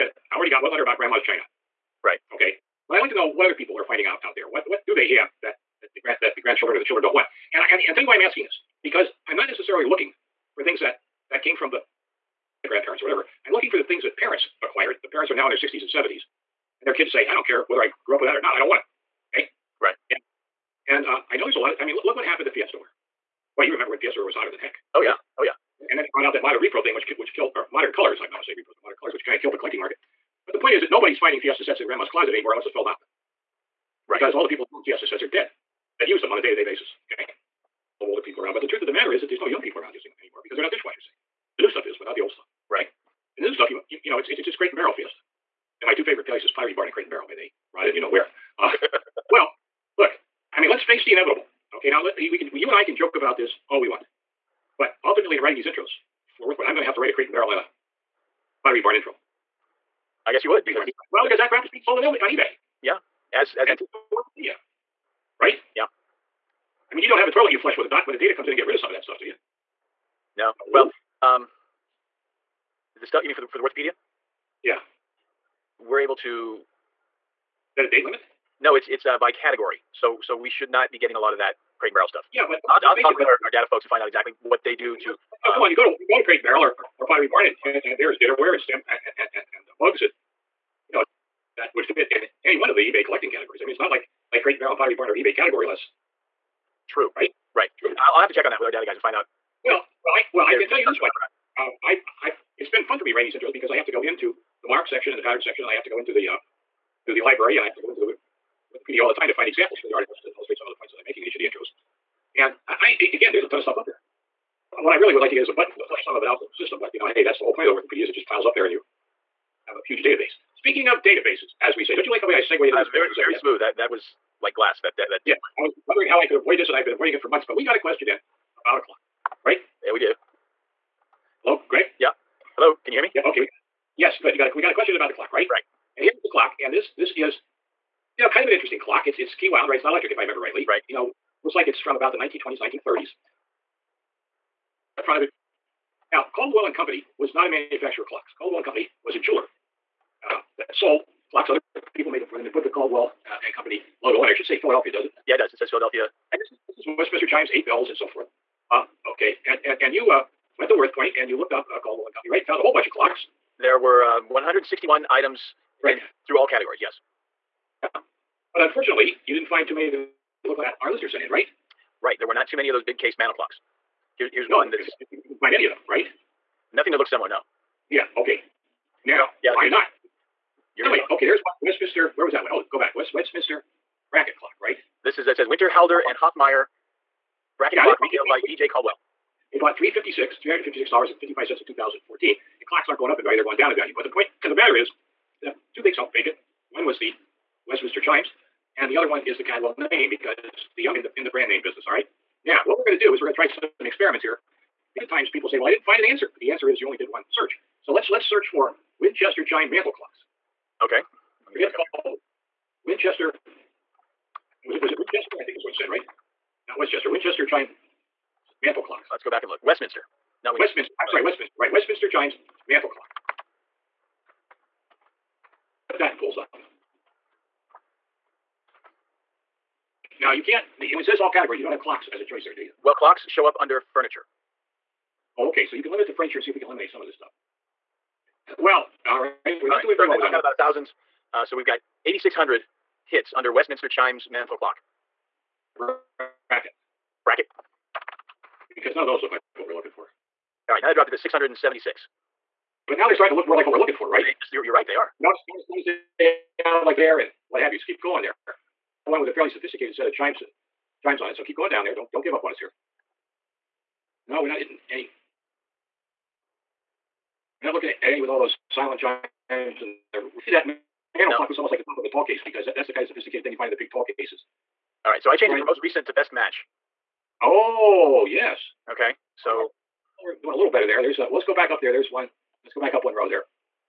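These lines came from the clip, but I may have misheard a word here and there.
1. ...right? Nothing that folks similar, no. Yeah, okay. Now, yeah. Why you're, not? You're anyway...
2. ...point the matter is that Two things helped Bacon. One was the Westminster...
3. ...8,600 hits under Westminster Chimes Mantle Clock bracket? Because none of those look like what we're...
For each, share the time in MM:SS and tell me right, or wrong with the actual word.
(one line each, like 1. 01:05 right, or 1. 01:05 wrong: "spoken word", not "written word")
1. 02:55 wrong: "looks", not "folks"
2. 03:14 right
3. 04:02 right.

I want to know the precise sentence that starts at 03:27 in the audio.
So let's let's search for Winchester chime mantle clocks.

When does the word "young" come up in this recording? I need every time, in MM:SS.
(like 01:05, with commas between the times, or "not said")
00:39, 03:20.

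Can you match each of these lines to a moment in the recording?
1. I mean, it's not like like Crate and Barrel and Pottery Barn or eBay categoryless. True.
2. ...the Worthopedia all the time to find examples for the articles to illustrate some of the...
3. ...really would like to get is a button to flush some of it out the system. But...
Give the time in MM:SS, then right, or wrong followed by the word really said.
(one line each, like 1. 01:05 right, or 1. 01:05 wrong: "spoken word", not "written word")
1. 01:33 right
2. 01:47 right
3. 01:54 right.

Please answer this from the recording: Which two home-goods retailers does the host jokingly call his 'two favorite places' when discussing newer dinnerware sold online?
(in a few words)
Pottery Barn and Crate and Barrel.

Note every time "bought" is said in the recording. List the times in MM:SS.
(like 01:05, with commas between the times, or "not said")
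03:09.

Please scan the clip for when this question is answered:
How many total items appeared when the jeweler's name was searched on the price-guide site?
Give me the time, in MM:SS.
02:44.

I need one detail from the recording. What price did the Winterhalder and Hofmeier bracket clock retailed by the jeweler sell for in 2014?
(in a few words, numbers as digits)
$356.55.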